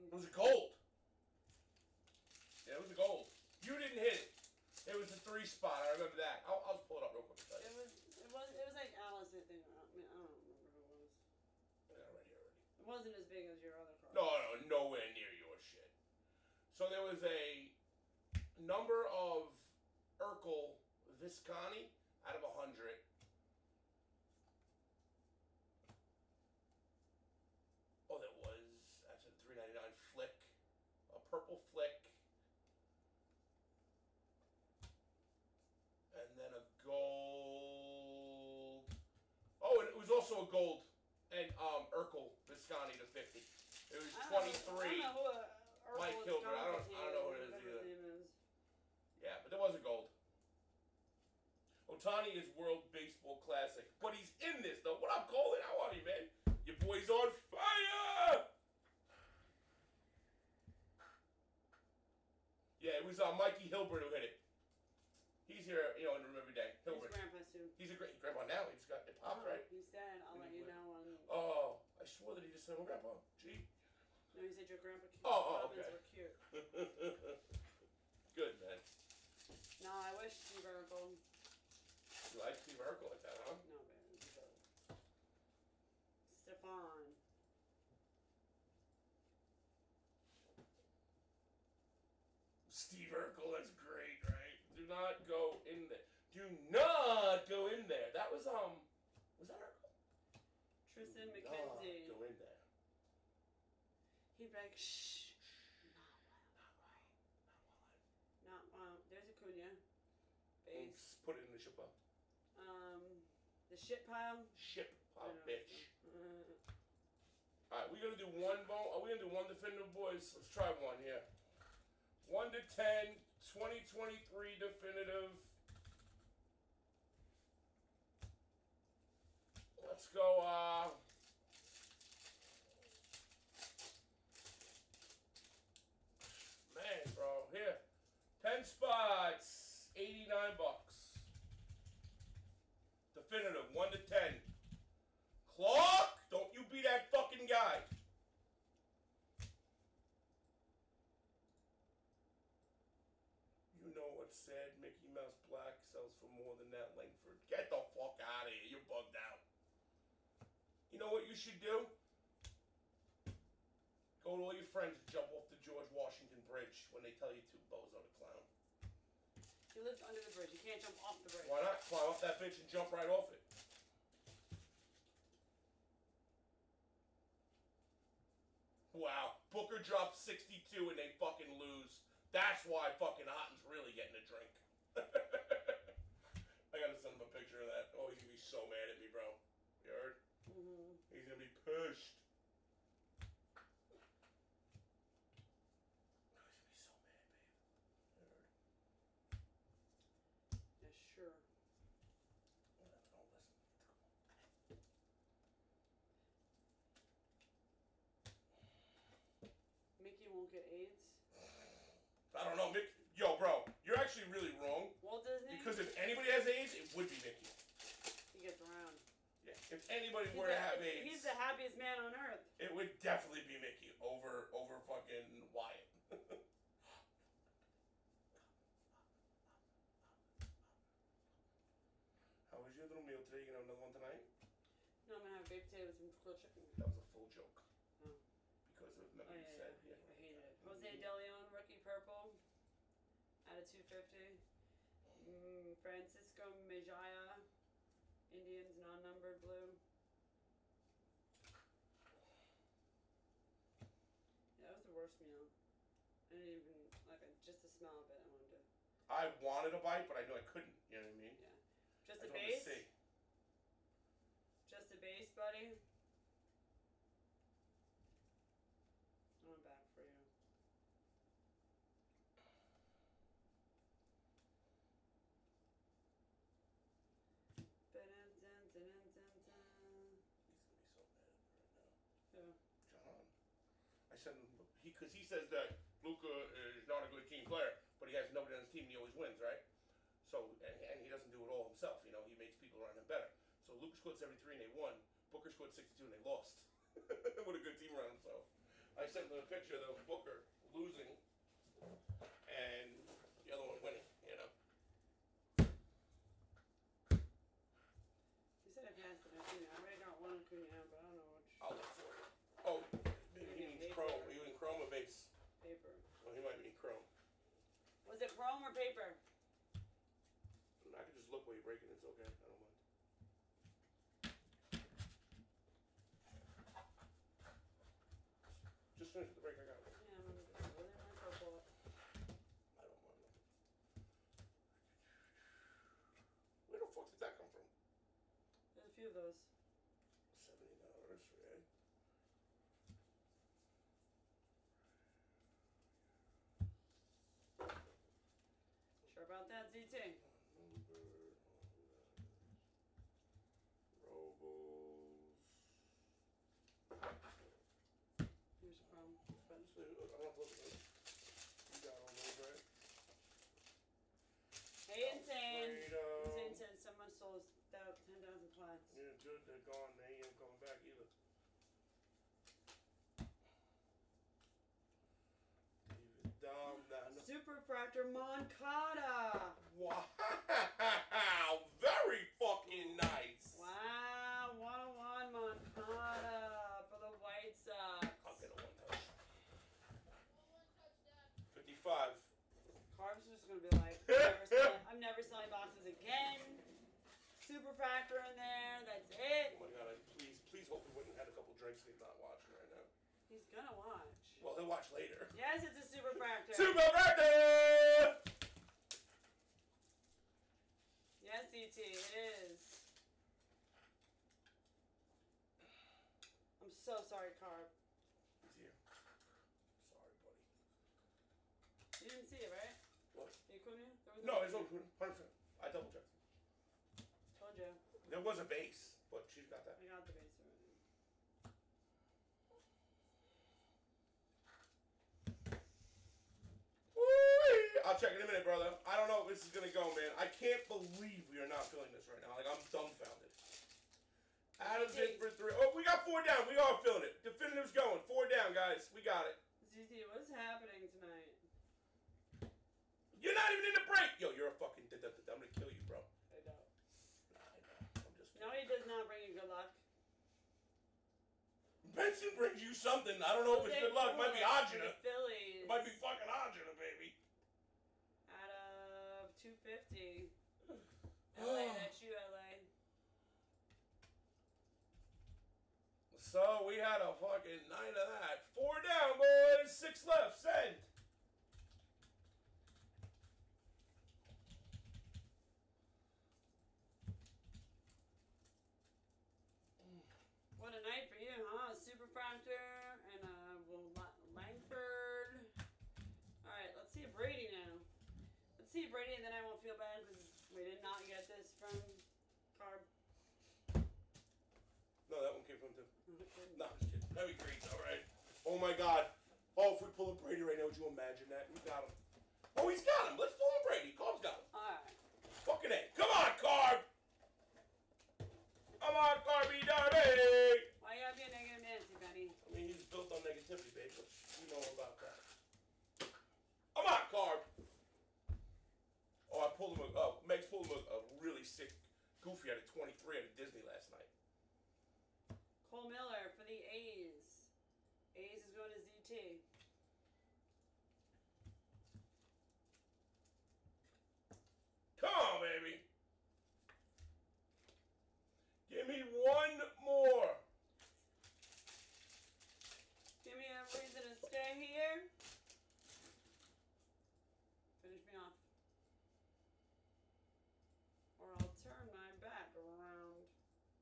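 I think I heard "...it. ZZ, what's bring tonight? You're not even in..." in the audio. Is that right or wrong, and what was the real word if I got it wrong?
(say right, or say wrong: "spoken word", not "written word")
wrong: "happening", not "bring".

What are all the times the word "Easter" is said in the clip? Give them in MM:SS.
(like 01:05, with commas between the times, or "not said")
not said.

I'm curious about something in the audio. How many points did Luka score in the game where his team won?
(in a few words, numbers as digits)
73.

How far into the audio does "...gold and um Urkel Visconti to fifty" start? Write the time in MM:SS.
00:40.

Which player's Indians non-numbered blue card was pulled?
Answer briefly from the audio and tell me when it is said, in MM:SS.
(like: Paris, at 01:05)
Francisco Mejia, at 04:05.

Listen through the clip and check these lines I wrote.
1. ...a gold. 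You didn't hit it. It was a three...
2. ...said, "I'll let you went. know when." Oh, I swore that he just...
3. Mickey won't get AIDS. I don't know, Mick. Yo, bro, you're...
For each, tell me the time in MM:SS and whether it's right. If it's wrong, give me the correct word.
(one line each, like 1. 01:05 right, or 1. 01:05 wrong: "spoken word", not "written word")
1. 00:02 right
2. 01:09 right
3. 03:30 right.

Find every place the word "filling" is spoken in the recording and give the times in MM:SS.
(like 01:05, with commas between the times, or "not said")
07:21, 07:26.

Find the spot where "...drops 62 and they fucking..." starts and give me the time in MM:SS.
02:59.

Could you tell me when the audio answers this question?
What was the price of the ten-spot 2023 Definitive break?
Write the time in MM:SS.
02:19.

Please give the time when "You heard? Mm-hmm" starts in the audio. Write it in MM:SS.
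03:09.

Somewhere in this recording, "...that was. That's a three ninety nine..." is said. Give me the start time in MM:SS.
00:28.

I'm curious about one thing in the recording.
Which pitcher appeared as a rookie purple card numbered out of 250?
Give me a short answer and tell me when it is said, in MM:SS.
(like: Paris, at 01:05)
Jose De Leon, at 04:00.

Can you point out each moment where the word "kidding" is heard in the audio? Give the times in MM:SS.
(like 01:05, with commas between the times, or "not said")
07:38, 08:26.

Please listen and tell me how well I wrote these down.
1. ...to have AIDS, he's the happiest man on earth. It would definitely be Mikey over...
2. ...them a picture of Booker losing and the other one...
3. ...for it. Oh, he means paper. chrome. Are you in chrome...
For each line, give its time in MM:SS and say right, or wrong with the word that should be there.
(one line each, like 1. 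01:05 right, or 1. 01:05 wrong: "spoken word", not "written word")
1. 03:40 wrong: "Mickey", not "Mikey"
2. 04:59 right
3. 05:11 right.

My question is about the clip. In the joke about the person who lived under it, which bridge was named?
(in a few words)
George Washington Bridge.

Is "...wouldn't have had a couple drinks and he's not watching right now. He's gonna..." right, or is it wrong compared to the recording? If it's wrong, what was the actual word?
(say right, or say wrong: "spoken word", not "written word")
right.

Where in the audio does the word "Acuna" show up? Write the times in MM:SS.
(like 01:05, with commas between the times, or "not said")
01:49, 07:04.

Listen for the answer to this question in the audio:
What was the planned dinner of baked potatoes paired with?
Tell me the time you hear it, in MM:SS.
03:56.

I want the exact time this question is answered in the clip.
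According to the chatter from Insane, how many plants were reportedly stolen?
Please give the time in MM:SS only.
06:07.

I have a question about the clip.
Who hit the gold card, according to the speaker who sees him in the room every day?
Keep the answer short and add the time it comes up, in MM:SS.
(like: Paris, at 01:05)
Mikey Hilbert, at 01:03.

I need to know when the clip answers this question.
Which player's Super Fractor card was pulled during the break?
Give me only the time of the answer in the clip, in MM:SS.
06:18.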